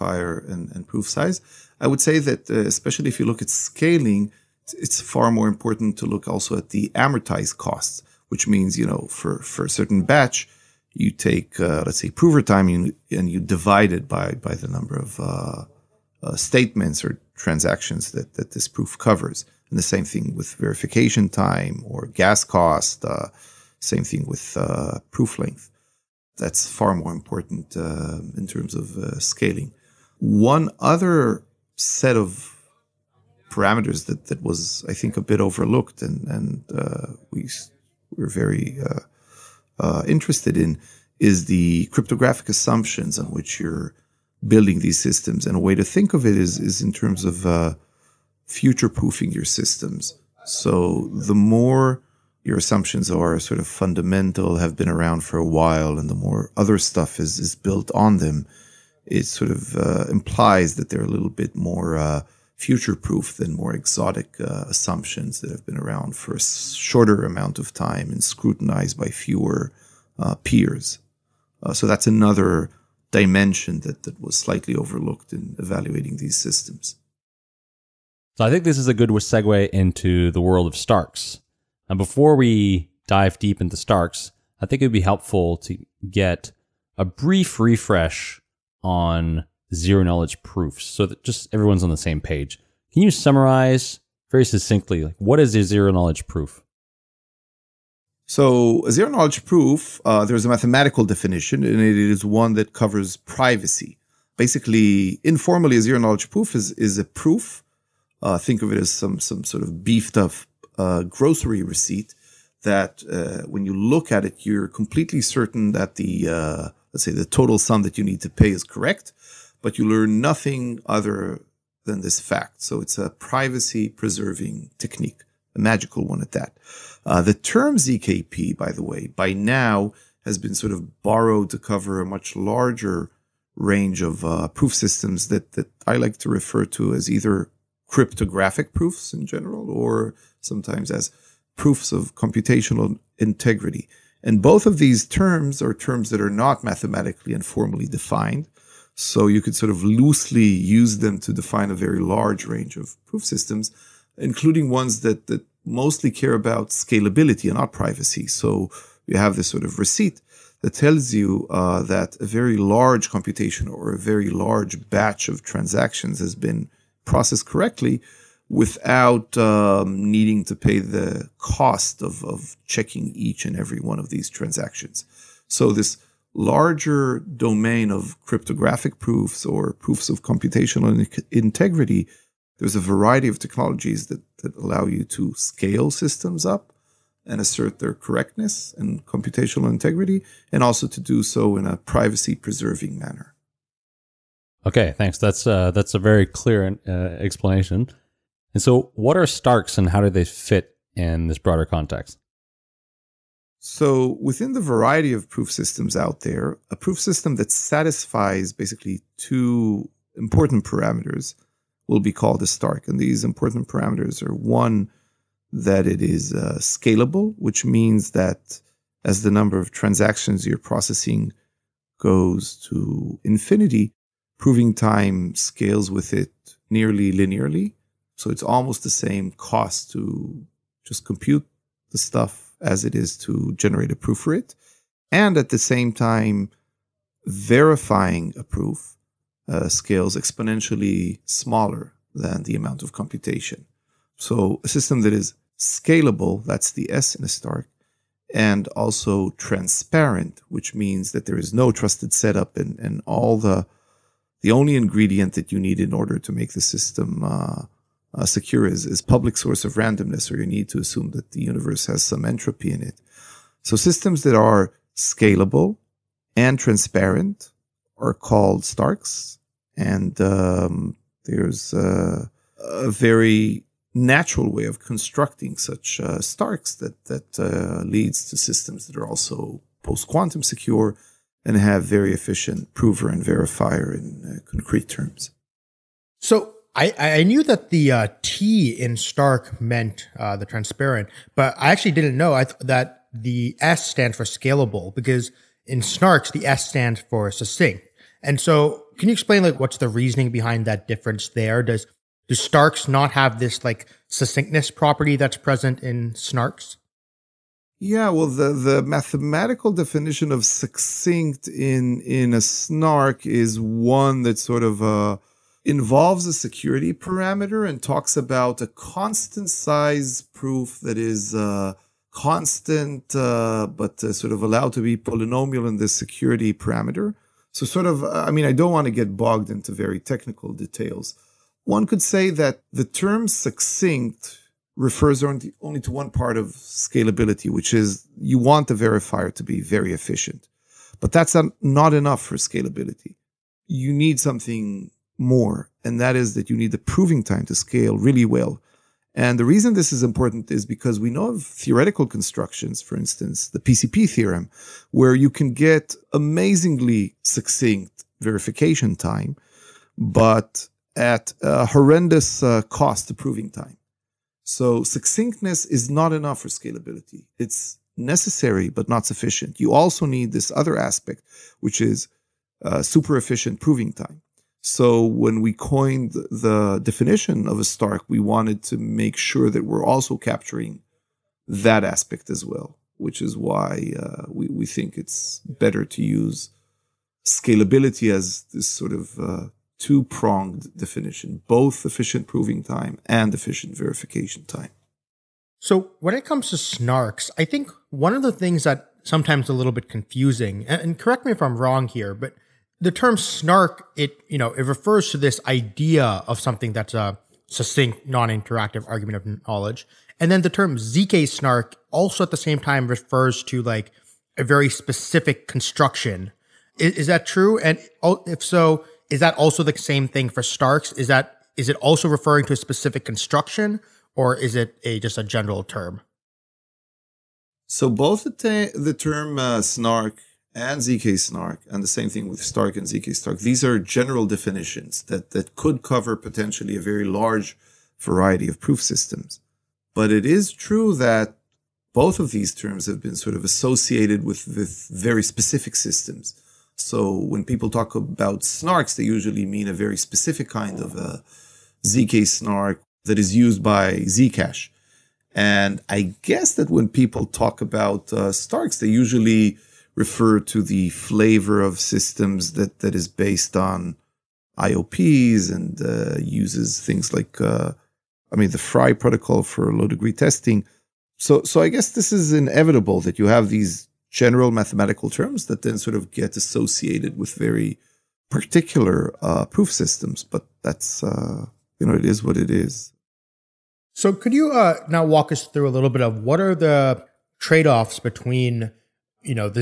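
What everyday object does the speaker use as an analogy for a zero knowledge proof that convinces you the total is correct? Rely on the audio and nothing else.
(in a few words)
grocery receipt.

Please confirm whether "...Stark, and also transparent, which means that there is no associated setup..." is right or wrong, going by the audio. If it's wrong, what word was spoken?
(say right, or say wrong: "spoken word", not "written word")
wrong: "trusted", not "associated".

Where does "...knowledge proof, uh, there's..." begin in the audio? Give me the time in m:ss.
1:39.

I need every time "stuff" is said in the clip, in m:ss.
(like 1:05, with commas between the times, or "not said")
0:56, 3:51.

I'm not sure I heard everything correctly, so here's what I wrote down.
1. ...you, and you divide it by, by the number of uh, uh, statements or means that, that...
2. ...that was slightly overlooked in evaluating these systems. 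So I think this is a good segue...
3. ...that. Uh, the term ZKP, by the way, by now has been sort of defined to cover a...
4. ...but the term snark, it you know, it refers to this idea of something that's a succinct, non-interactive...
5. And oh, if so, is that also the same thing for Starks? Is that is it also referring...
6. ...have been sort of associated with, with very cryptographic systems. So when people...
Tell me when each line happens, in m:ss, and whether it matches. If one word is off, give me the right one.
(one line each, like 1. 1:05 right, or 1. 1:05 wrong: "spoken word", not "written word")
1. 0:12 wrong: "transactions", not "means"
2. 1:14 right
3. 2:06 wrong: "borrowed", not "defined"
4. 6:42 right
5. 6:57 right
6. 7:22 wrong: "specific", not "cryptographic".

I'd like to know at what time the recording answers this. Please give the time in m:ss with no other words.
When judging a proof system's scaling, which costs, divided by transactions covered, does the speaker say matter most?
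0:06.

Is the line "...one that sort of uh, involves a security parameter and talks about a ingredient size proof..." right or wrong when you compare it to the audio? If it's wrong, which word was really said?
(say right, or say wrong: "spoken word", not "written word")
wrong: "constant", not "ingredient".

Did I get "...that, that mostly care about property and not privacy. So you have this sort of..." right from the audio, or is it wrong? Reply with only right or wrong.
wrong.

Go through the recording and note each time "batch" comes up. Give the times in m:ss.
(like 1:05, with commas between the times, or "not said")
0:10, 2:44.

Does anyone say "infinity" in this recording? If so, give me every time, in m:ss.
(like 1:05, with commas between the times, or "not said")
3:43.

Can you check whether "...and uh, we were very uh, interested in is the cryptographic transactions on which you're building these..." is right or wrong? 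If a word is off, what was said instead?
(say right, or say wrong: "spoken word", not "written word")
wrong: "assumptions", not "transactions".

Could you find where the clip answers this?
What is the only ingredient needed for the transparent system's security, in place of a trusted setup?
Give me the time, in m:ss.
4:19.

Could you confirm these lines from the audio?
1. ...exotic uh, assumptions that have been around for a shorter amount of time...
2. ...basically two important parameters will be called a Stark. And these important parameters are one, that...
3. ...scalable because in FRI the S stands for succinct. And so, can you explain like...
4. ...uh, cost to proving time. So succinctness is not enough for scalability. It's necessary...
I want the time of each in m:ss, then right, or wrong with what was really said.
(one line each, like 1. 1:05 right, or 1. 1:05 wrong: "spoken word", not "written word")
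1. 1:03 right
2. 3:28 right
3. 4:54 wrong: "Snarks", not "FRI"
4. 6:02 right.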